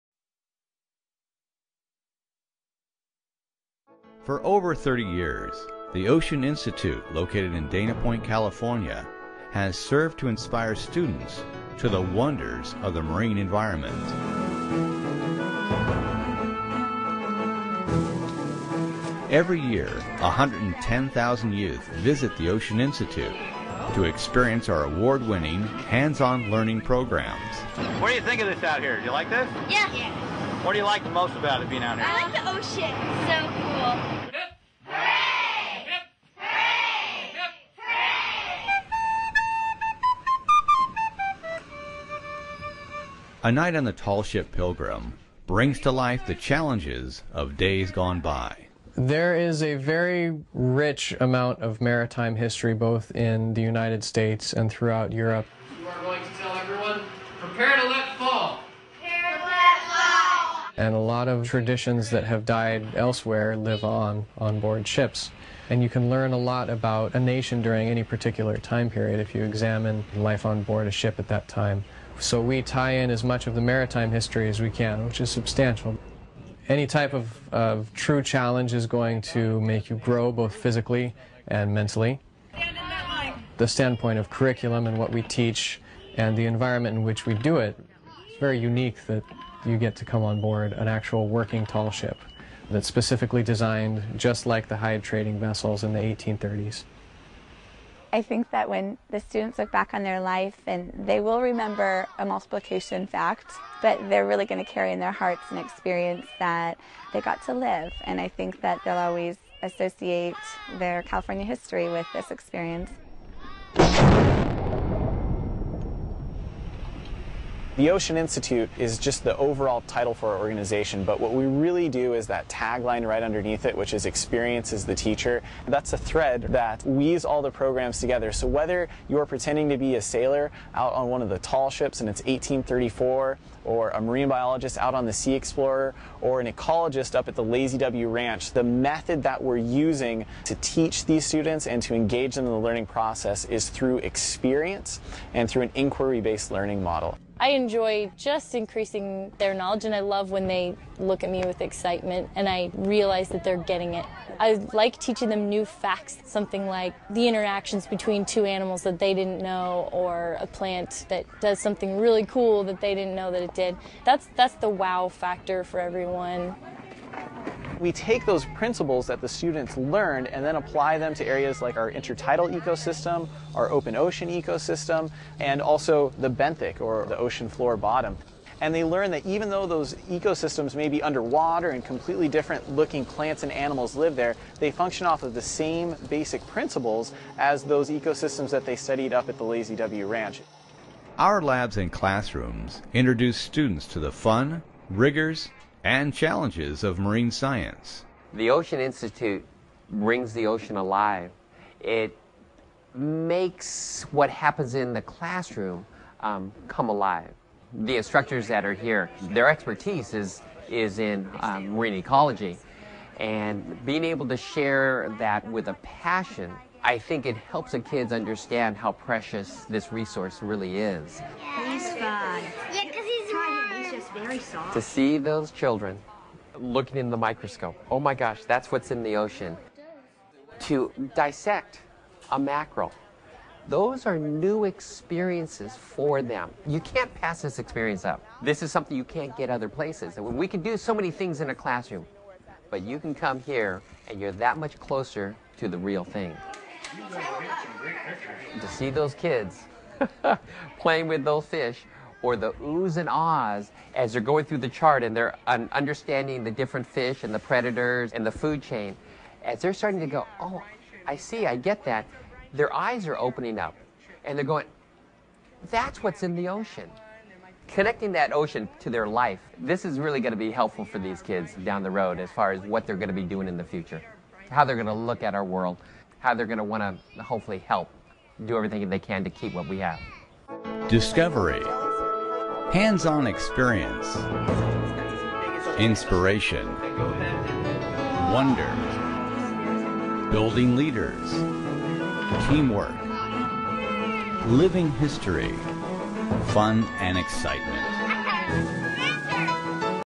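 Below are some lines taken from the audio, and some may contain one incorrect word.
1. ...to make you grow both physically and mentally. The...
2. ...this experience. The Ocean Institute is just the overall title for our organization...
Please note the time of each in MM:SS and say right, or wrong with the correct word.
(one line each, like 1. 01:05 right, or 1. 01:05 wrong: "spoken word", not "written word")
1. 01:19 right
2. 01:52 right.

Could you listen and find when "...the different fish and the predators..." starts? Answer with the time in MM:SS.
04:16.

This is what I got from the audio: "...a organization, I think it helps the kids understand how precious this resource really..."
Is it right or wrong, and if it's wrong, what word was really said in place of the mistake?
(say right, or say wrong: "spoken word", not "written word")
wrong: "passion", not "organization".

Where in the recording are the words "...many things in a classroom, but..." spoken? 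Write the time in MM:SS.
04:00.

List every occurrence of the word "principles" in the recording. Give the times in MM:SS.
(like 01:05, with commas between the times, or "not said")
02:48, 03:06.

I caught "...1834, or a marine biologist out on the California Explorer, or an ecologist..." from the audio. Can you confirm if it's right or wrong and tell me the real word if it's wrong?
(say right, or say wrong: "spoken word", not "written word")
wrong: "Sea", not "California".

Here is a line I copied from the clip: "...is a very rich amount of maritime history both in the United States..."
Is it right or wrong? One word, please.
right.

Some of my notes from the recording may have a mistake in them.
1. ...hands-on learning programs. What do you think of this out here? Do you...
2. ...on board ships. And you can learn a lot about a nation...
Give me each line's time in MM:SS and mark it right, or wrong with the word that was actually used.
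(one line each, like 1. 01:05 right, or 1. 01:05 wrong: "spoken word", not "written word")
1. 00:25 right
2. 01:04 right.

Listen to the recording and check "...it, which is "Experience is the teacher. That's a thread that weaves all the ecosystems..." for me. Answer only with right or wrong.
wrong.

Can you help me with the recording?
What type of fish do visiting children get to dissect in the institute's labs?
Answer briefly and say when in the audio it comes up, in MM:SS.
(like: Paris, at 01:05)
mackerel, at 03:52.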